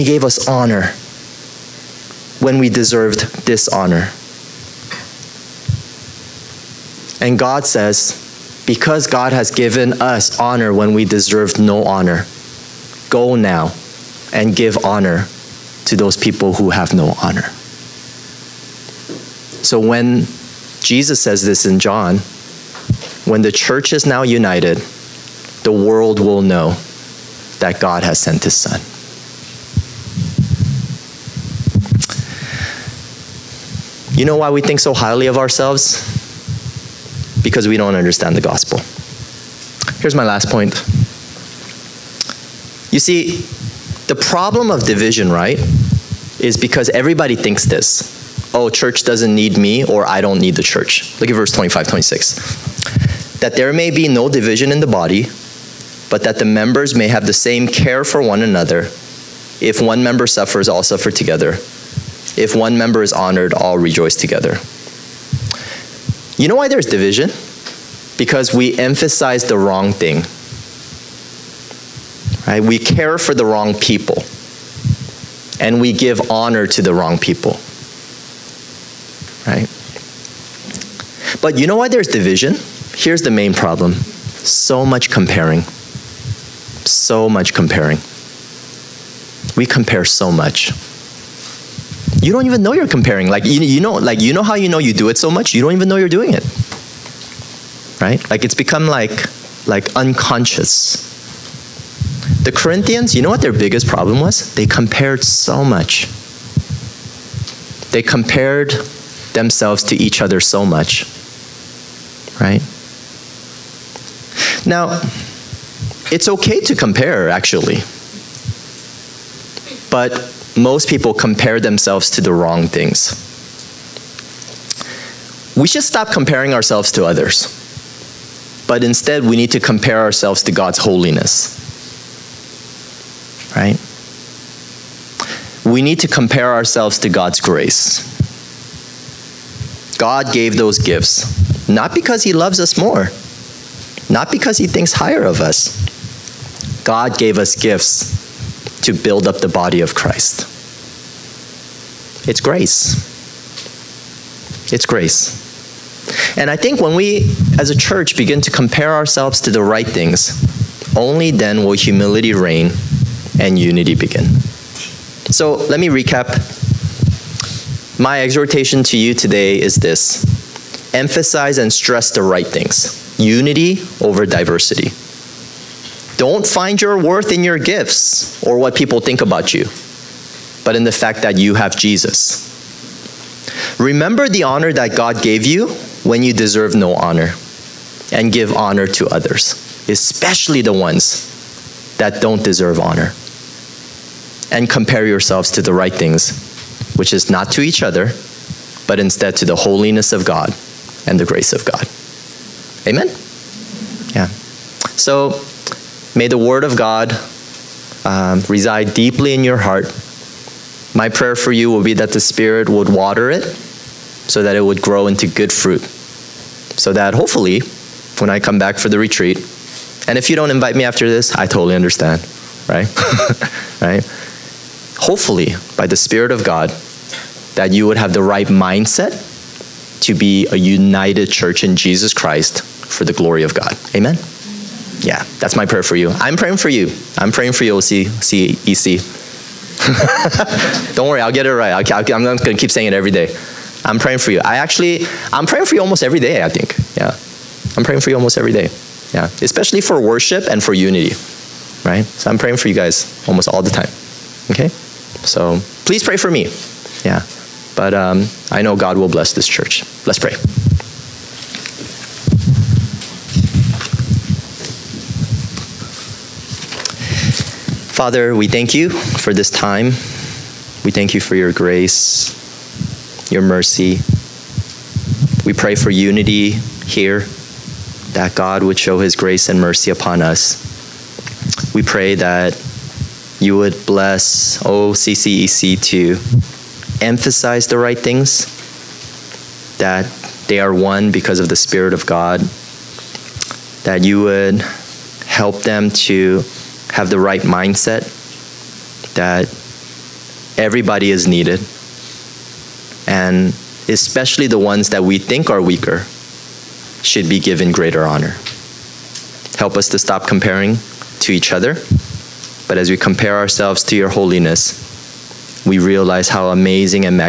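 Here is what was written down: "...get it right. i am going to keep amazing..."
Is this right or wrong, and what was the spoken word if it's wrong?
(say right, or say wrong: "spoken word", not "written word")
wrong: "saying", not "amazing".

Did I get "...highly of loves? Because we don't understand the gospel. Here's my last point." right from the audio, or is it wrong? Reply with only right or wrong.
wrong.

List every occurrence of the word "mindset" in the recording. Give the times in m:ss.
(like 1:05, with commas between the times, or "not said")
3:48, 4:57.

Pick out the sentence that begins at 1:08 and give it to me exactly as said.
Because we emphasize the wrong thing.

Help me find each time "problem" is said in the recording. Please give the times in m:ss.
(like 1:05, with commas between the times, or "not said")
0:44, 1:23, 1:43.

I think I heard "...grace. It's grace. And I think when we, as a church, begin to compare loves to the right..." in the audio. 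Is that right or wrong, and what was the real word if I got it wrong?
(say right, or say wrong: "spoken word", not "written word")
wrong: "ourselves", not "loves".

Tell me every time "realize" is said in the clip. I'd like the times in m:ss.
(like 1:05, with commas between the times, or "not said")
5:15.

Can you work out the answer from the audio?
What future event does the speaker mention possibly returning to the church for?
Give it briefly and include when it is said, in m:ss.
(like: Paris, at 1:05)
The retreat, at 3:38.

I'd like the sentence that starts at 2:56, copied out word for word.
Don't find your worth in your gifts or what people think about you, but in the fact that you have Jesus.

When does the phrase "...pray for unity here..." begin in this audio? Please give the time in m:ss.
4:35.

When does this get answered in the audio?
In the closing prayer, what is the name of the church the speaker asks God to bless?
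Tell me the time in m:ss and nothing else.
4:44.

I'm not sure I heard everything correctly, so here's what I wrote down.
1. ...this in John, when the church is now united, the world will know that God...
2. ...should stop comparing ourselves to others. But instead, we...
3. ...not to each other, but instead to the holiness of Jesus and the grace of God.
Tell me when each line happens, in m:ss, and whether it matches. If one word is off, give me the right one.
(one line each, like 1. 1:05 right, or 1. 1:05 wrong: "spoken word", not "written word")
1. 0:21 right
2. 2:05 right
3. 3:17 wrong: "God", not "Jesus".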